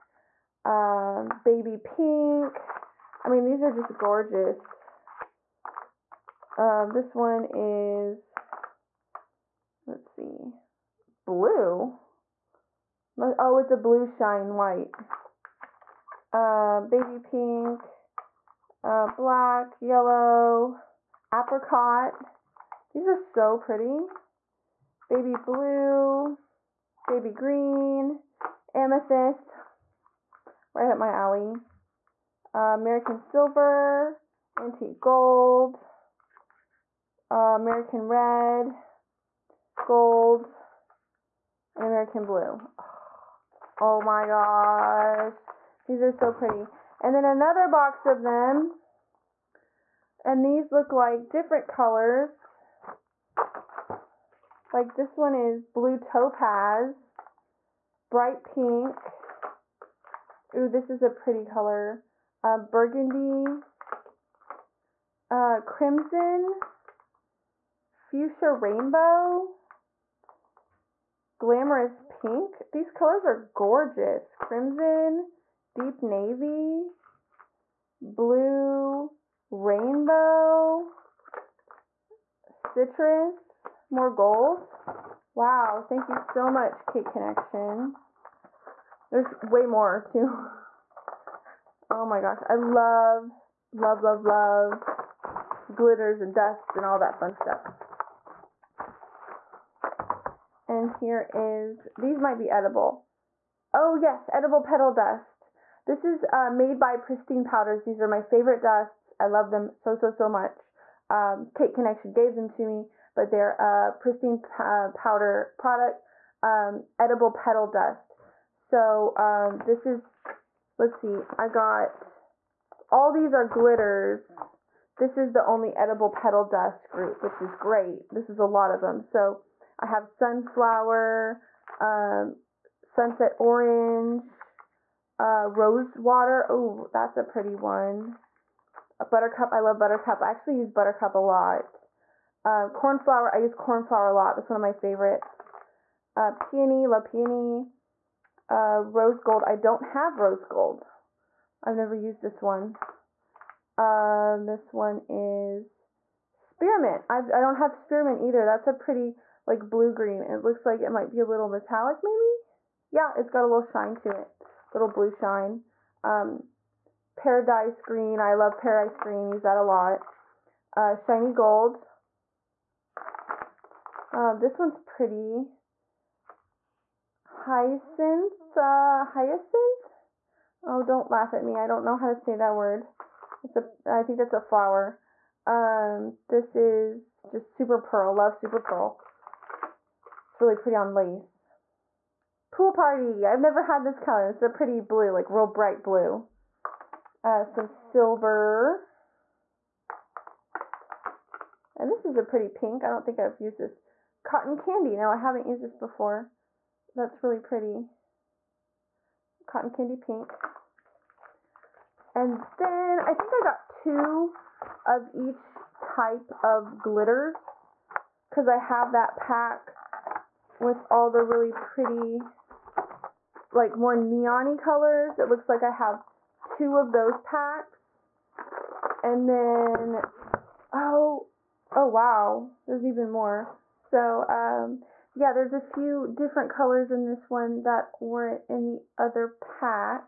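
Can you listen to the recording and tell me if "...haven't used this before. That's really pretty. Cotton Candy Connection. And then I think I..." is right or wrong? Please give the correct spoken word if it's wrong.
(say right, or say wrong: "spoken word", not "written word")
wrong: "Pink", not "Connection".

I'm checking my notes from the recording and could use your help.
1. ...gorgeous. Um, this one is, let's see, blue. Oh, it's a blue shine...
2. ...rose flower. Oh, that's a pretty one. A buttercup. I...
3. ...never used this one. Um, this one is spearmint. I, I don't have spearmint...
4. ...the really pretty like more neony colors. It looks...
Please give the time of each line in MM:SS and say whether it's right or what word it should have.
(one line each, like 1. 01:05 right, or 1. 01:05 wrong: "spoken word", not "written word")
1. 00:03 right
2. 02:15 wrong: "water", not "flower"
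3. 02:31 right
4. 03:41 right.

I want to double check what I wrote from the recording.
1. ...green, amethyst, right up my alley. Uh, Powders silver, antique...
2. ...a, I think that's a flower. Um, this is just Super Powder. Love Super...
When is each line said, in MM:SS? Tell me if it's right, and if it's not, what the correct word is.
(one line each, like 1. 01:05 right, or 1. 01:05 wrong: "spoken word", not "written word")
1. 00:27 wrong: "American", not "Powders"
2. 03:03 wrong: "Pearl", not "Powder".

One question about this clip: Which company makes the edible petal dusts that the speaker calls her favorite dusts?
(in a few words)
Pristine Powders.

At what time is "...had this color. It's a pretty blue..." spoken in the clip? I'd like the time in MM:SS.
03:13.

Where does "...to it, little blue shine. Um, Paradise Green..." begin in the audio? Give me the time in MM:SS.
02:43.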